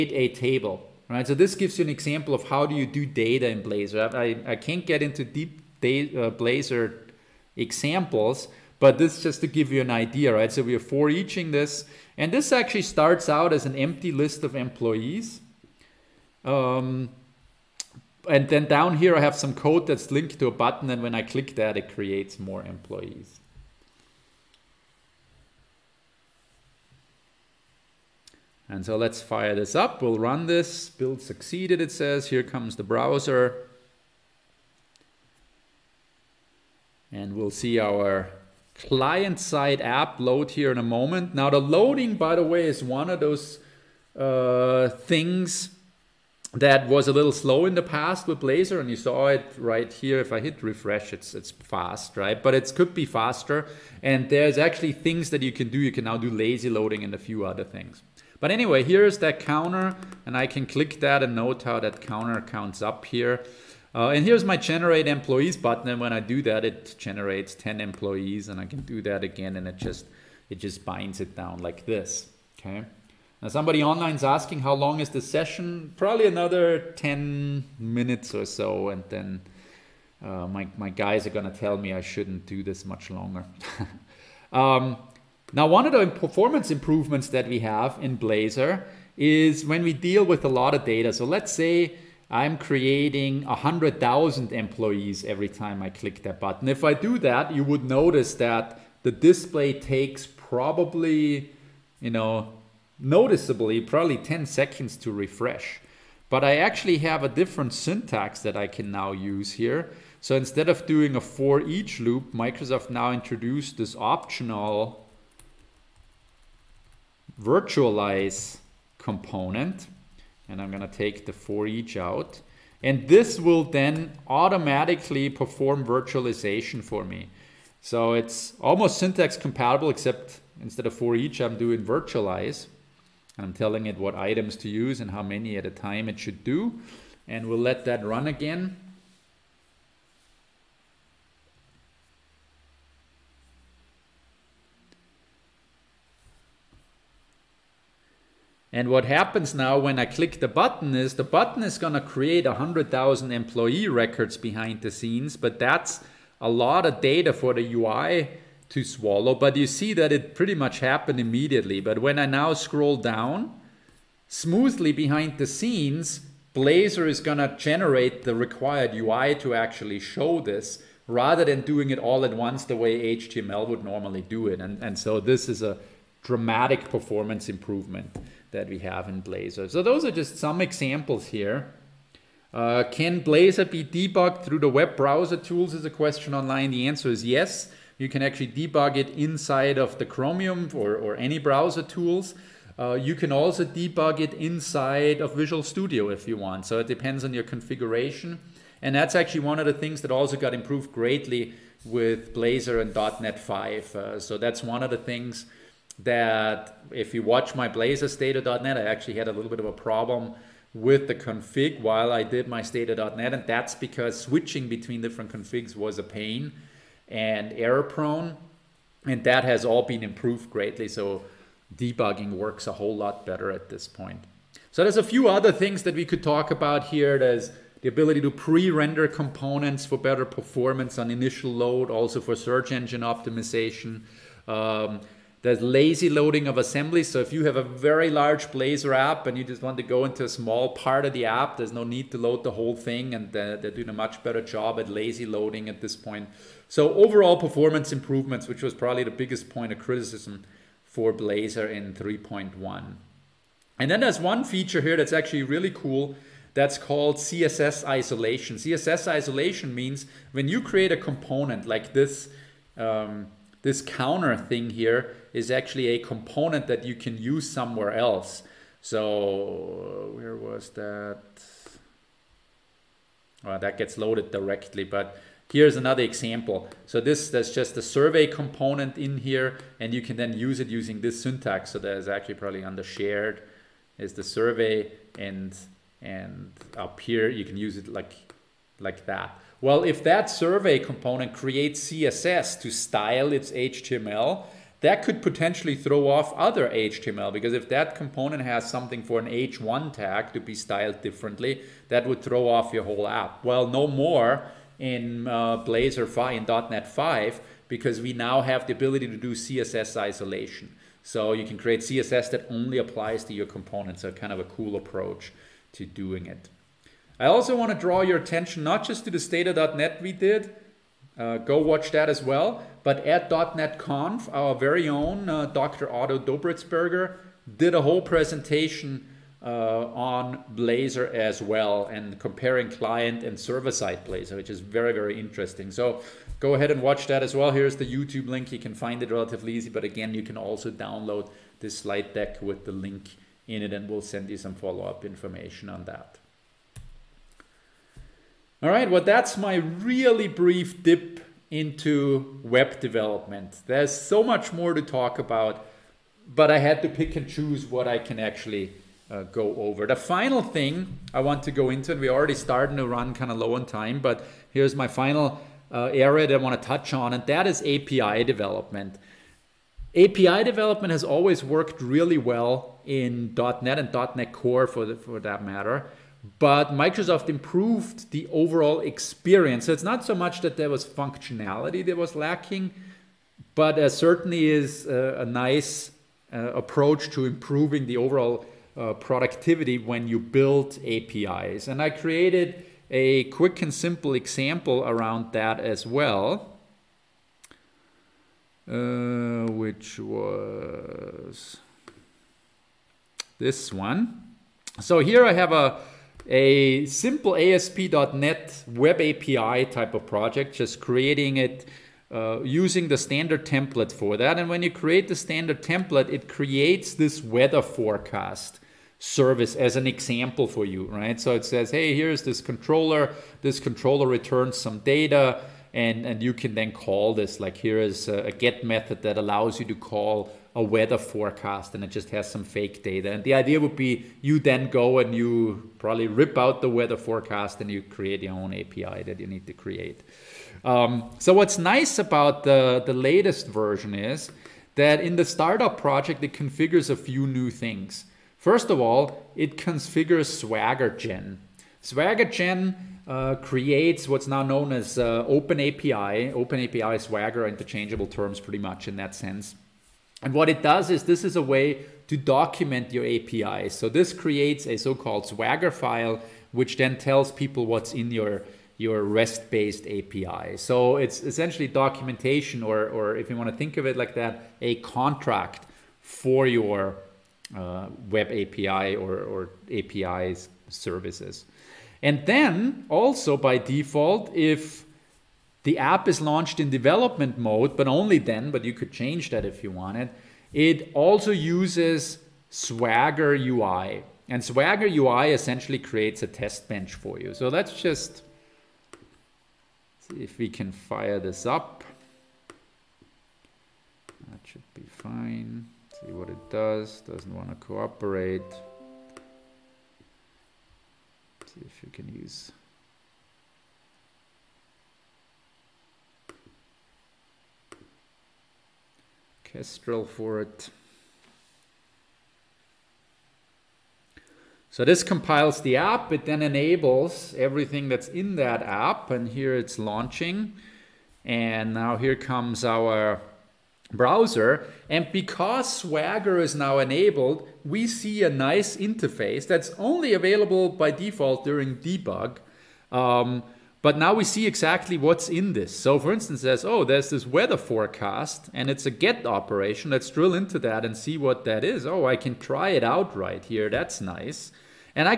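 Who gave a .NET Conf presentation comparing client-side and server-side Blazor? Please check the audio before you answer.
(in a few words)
Dr. Otto Dobretsberger.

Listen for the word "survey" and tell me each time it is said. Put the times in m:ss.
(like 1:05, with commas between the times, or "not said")
4:37, 4:44, 4:50.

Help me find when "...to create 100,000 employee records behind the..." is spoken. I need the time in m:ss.
2:31.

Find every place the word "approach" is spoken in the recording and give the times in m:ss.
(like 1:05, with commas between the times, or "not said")
5:14, 6:26.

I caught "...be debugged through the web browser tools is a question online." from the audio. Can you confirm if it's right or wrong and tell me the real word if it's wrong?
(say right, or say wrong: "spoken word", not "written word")
right.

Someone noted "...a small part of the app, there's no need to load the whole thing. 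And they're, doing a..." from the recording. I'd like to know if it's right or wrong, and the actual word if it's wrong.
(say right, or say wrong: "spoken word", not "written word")
right.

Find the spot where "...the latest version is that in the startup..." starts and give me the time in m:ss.
7:22.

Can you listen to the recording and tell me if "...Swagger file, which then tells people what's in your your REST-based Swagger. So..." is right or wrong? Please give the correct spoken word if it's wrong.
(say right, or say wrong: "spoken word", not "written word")
wrong: "API", not "Swagger".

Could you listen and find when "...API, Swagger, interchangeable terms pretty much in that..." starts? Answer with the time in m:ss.
7:36.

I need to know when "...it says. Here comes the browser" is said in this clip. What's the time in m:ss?
0:31.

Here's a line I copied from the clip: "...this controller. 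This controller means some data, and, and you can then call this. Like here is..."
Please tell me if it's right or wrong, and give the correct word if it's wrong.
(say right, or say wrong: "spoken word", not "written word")
wrong: "returns", not "means".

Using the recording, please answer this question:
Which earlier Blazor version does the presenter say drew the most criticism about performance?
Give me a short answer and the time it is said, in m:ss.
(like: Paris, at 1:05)
3.1, at 4:11.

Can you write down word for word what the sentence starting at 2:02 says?
And this will then automatically perform virtualization for me.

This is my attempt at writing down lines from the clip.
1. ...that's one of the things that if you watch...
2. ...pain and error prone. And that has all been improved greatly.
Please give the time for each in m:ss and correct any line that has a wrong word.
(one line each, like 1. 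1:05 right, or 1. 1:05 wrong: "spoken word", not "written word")
1. 3:24 right
2. 3:36 right.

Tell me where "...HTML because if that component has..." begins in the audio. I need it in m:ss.
4:56.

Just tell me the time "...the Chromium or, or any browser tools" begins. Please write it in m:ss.
3:09.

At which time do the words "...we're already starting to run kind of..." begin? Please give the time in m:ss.
6:02.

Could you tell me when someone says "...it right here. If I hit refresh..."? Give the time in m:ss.
0:49.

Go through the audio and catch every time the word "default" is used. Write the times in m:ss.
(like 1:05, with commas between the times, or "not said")
8:03, 9:00.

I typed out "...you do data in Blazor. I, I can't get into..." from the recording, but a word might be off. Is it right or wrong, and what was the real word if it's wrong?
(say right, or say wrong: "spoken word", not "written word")
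right.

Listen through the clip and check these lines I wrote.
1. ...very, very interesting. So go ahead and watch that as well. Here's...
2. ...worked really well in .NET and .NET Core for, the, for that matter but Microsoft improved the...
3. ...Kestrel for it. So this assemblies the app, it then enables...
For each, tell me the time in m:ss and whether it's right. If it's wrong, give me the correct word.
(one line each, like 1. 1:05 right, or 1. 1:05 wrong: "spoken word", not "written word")
1. 5:34 right
2. 6:11 right
3. 8:39 wrong: "compiles", not "assemblies".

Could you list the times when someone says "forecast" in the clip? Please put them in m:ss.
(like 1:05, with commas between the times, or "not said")
6:57, 7:10, 7:16, 9:07.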